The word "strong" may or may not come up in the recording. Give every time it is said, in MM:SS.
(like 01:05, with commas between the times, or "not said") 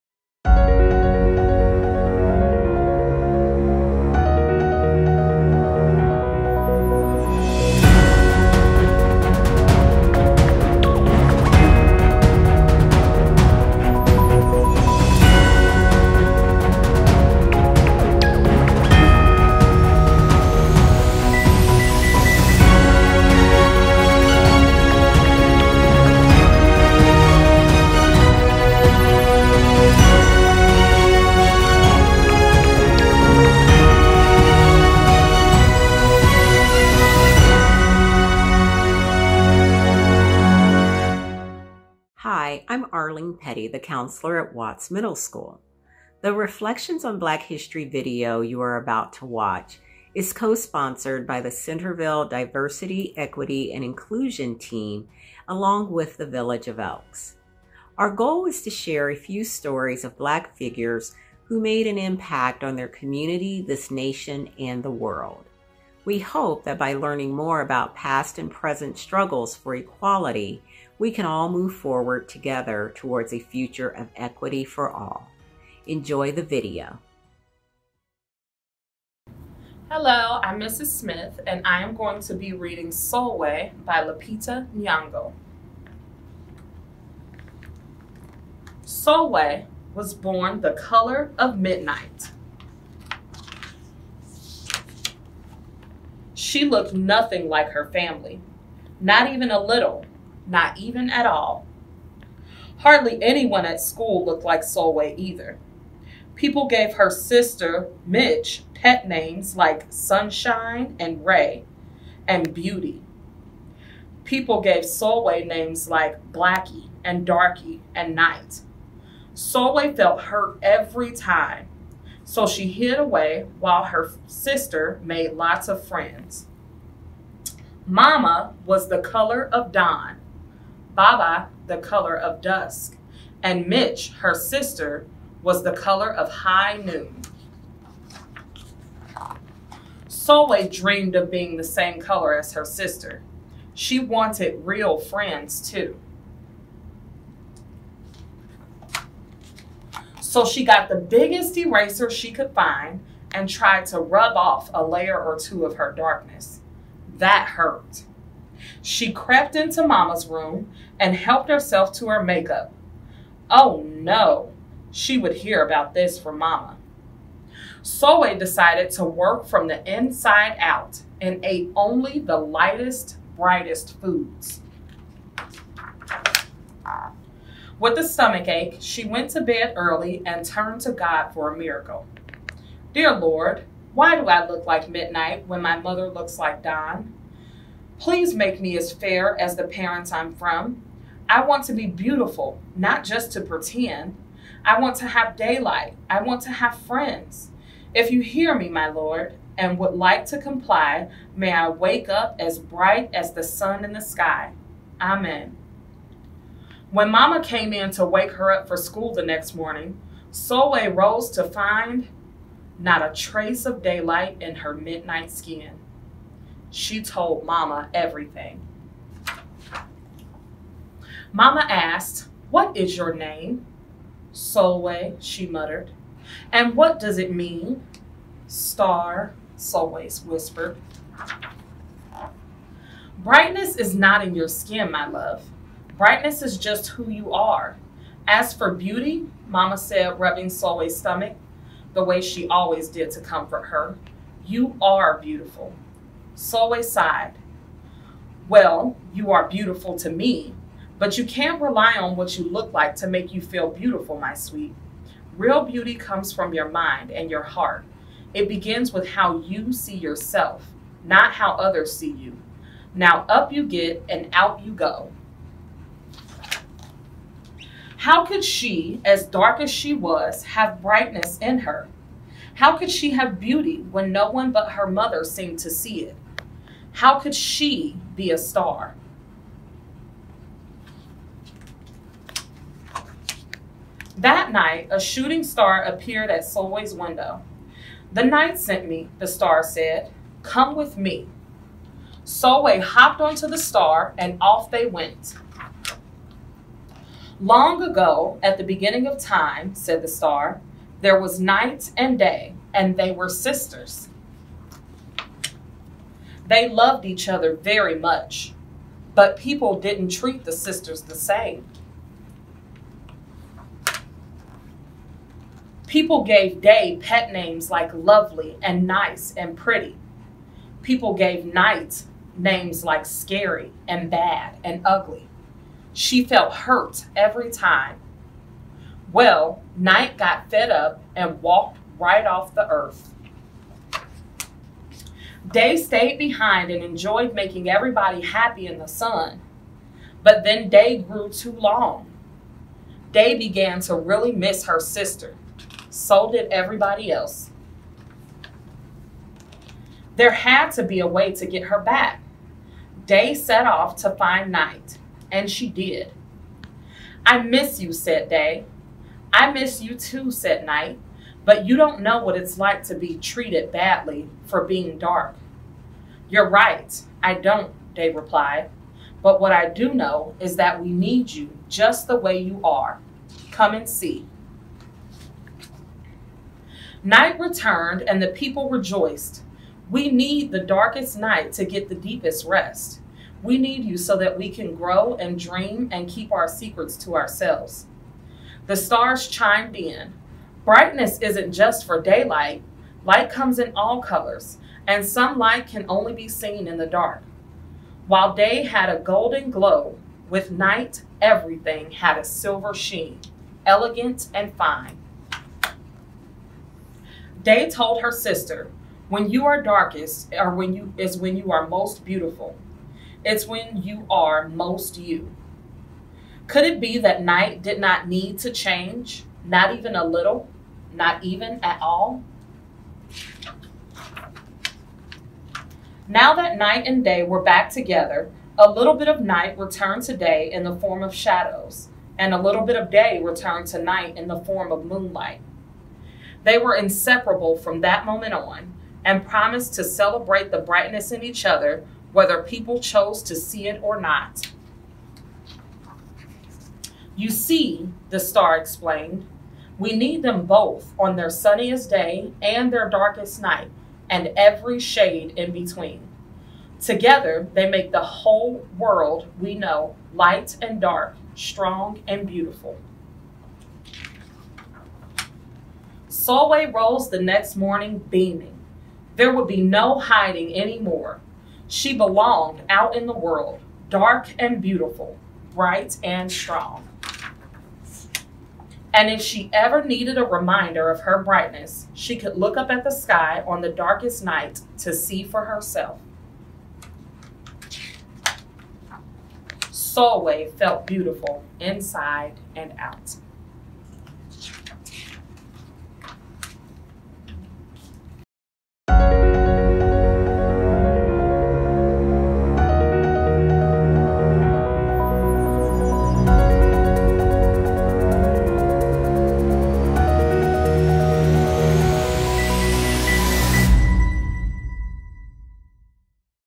07:41, 07:56.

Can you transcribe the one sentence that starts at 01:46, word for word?
People gave her sister, Mitch, pet names like Sunshine and Ray and Beauty.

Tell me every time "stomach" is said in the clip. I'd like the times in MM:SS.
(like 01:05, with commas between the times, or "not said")
02:58, 04:00.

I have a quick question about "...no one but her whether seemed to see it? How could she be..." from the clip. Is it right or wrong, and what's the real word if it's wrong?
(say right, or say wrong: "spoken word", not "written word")
wrong: "mother", not "whether".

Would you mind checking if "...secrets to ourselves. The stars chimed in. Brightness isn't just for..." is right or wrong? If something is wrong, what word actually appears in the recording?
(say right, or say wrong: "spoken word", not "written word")
right.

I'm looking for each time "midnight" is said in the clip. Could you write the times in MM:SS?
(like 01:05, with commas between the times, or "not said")
01:31, 03:04, 03:34.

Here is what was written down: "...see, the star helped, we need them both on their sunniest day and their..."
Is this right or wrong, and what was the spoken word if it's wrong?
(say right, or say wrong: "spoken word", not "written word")
wrong: "explained", not "helped".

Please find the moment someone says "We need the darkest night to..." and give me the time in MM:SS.
06:19.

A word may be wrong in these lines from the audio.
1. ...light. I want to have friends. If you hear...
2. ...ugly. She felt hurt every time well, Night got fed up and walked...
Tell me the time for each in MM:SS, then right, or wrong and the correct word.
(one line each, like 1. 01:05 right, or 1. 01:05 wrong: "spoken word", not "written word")
1. 03:15 wrong: "daylight", not "light"
2. 05:24 right.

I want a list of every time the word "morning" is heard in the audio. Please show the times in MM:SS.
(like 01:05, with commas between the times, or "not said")
03:29, 07:47.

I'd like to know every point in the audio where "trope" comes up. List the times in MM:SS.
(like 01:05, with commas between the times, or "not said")
not said.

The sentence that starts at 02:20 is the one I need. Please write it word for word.
Sulwe dreamed of being the same color as her sister.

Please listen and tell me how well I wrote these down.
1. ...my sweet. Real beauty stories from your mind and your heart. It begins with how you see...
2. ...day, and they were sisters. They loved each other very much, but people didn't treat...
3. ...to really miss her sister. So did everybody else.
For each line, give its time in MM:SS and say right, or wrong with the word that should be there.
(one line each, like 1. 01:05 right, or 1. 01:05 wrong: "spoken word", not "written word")
1. 04:14 wrong: "comes", not "stories"
2. 05:02 right
3. 05:43 right.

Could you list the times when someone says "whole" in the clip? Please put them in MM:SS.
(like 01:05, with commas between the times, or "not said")
07:38.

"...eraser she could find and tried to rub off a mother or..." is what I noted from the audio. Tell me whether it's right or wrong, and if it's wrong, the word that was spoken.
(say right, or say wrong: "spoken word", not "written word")
wrong: "layer", not "mother".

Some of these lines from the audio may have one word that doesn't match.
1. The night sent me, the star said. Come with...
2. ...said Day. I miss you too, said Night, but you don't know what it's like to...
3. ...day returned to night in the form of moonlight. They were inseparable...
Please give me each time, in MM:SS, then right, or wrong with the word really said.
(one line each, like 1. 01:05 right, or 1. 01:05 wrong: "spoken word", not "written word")
1. 04:48 right
2. 05:57 right
3. 07:12 right.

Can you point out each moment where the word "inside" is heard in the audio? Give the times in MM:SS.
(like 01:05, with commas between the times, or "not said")
02:49, 08:11.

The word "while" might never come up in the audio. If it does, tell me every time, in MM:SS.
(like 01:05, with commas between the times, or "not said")
02:03, 06:38.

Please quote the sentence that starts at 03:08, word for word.
Please make me as fair as the parents I'm from.